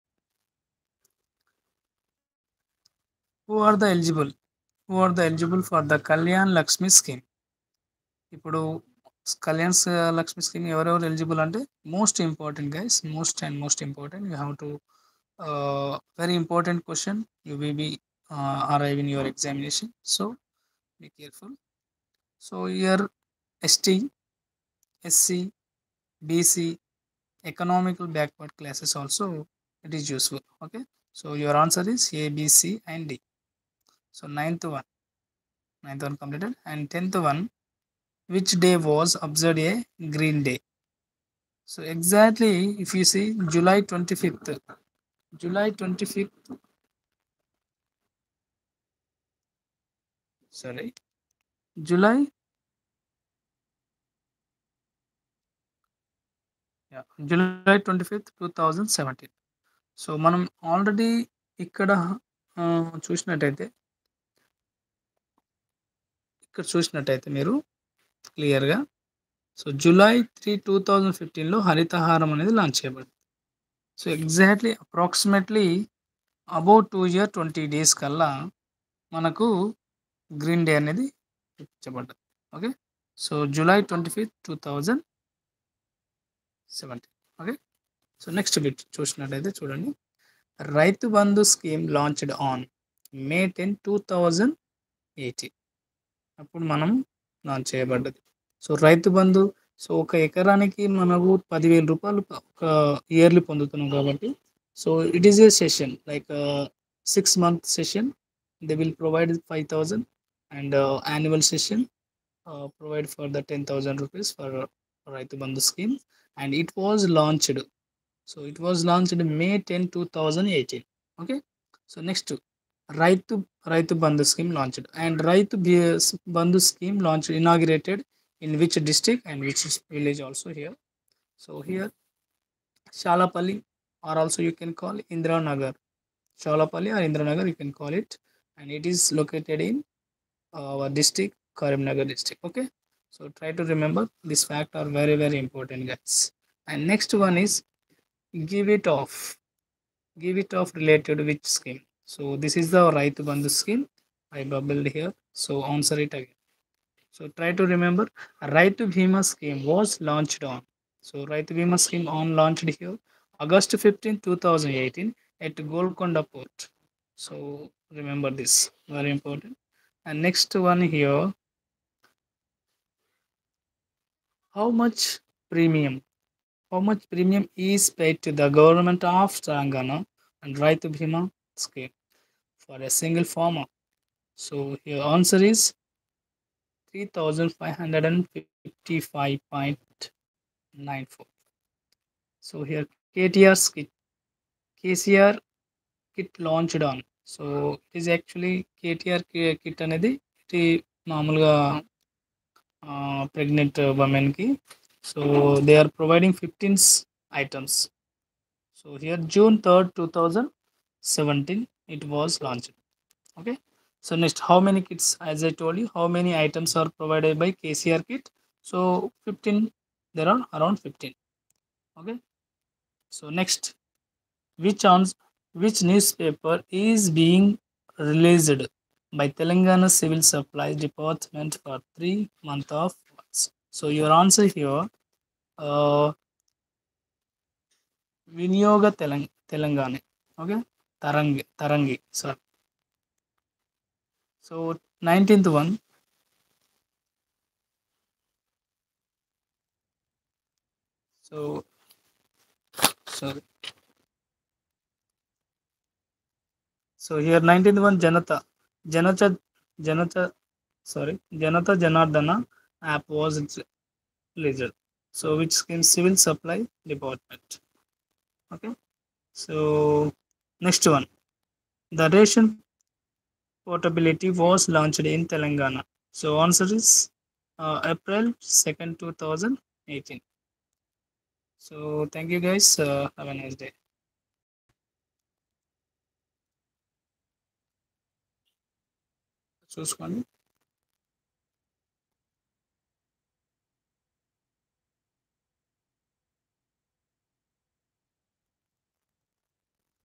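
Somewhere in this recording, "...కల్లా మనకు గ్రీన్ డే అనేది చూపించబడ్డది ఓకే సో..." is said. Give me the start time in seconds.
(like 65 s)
78 s.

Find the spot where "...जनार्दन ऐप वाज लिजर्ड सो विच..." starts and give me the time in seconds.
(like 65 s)
261 s.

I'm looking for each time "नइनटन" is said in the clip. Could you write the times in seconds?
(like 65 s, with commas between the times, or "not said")
245 s, 257 s.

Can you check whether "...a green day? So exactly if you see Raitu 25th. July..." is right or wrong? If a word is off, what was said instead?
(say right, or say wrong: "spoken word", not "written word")
wrong: "July", not "Raitu".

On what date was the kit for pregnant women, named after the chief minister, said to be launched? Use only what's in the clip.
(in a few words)
June 3, 2017.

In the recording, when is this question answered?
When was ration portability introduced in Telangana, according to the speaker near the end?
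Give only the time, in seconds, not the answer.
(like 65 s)
277 s.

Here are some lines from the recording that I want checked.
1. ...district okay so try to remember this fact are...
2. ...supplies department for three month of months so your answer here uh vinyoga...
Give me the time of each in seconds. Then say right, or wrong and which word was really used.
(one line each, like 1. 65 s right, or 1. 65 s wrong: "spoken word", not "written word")
1. 142 s right
2. 230 s right.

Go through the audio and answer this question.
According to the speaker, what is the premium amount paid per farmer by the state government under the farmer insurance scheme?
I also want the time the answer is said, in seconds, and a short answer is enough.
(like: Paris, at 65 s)
3555.94, at 186 s.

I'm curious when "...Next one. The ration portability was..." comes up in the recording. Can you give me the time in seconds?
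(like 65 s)
270 s.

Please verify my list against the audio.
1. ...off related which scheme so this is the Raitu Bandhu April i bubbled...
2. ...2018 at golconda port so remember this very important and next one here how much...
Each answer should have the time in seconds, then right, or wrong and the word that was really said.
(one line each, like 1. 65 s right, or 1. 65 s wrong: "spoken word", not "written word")
1. 150 s wrong: "Scheme", not "April"
2. 164 s right.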